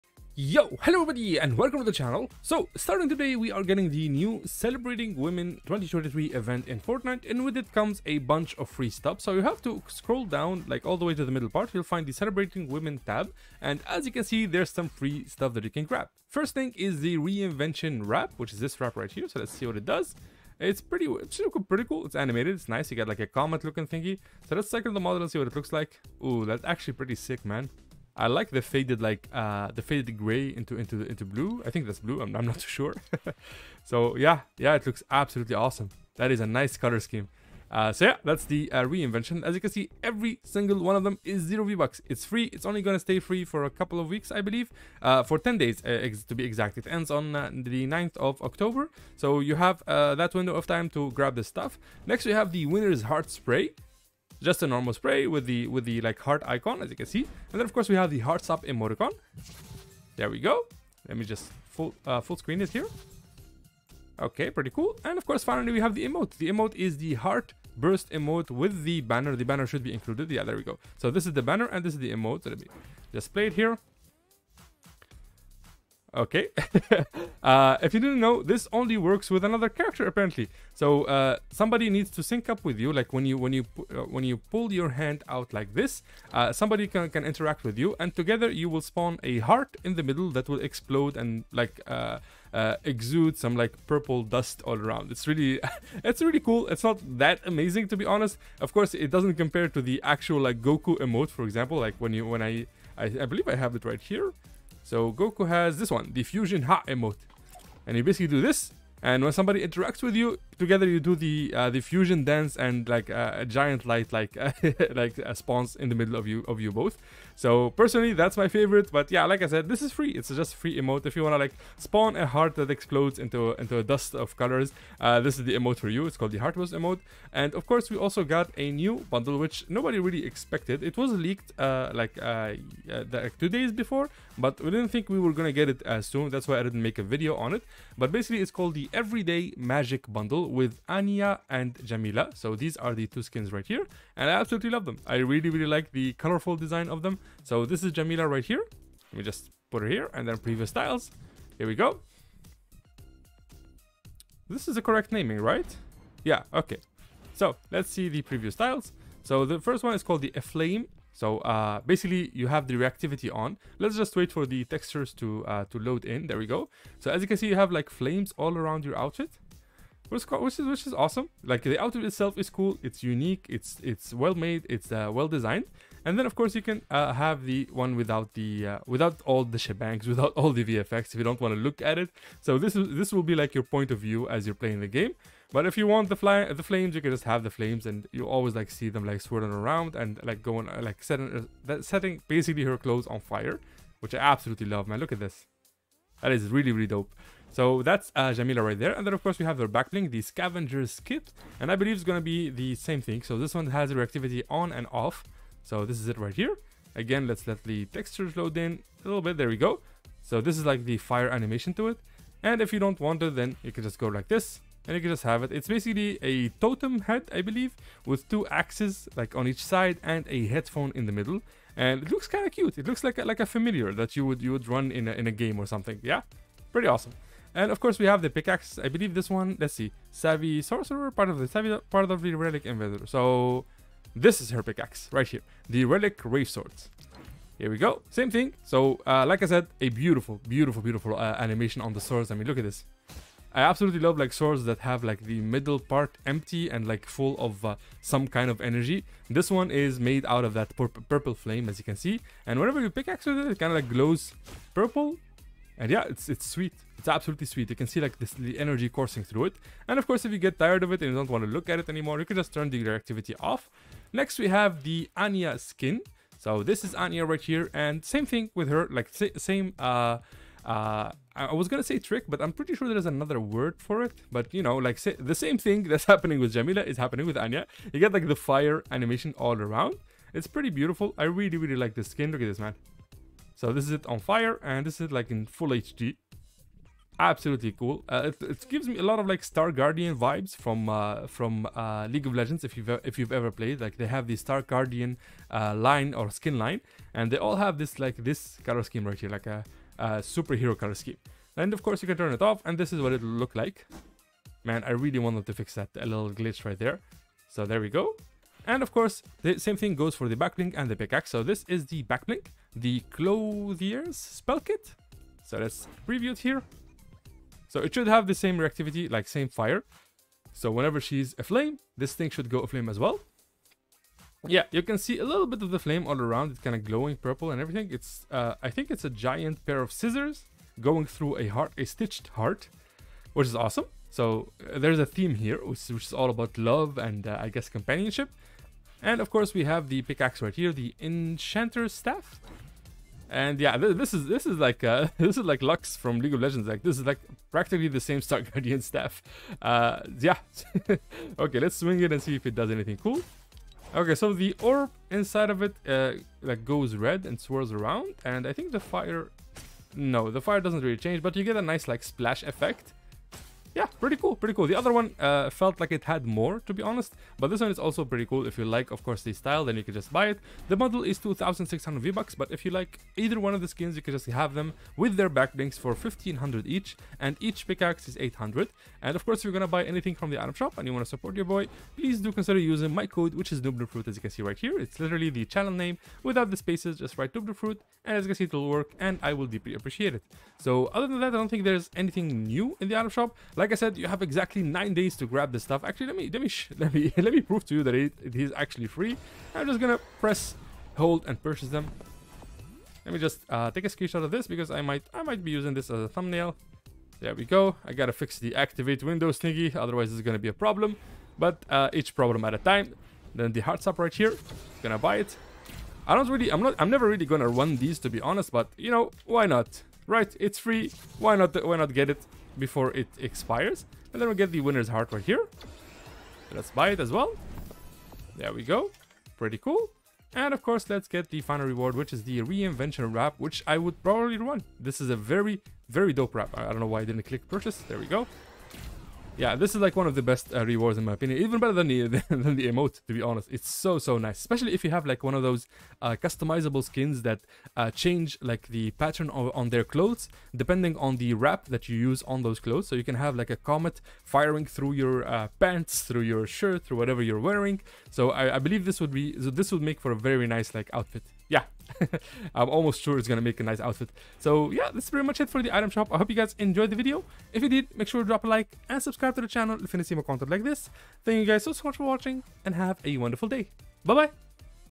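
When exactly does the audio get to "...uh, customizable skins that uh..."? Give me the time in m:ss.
7:25.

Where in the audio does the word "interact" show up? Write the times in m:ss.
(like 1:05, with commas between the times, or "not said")
1:27, 1:49.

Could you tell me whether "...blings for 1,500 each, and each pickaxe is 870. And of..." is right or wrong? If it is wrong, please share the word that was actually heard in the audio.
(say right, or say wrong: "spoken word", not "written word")
wrong: "800", not "870".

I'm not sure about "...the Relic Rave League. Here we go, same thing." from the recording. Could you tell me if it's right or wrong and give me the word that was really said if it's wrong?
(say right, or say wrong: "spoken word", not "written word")
wrong: "Swords", not "League".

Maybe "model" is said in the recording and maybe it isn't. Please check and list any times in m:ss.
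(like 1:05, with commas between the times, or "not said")
0:24, 6:10.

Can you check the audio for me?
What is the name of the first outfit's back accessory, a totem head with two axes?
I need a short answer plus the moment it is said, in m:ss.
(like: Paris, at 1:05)
Scavenger's Kit, at 3:20.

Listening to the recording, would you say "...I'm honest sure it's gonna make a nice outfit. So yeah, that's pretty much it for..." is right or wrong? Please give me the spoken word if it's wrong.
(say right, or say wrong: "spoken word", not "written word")
wrong: "almost", not "honest".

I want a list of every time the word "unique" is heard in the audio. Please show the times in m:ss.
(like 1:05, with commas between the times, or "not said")
2:53.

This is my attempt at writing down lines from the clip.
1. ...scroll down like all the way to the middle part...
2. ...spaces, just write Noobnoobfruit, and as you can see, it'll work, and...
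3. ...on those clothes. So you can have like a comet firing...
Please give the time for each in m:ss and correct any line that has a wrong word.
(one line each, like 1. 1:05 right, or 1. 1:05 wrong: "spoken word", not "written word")
1. 0:09 right
2. 6:26 right
3. 7:32 right.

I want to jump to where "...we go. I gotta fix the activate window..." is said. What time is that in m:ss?
6:47.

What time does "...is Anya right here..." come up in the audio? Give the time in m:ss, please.
4:26.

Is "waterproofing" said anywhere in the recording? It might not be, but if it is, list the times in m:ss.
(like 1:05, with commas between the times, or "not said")
not said.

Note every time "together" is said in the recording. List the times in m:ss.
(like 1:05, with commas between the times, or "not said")
1:28, 1:50.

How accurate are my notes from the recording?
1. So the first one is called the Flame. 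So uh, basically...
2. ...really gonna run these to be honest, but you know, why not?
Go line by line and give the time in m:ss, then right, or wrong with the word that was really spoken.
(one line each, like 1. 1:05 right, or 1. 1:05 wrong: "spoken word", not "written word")
1. 2:39 right
2. 6:57 right.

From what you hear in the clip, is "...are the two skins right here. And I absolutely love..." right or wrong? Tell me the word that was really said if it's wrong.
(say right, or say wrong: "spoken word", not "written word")
right.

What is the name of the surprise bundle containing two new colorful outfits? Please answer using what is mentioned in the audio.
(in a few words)
Everyday Magic Bundle.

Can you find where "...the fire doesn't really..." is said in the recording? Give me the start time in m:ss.
6:00.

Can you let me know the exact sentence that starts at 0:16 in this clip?
First thing is the reinvention wrap, which is this wrap right here, so let's see what it does.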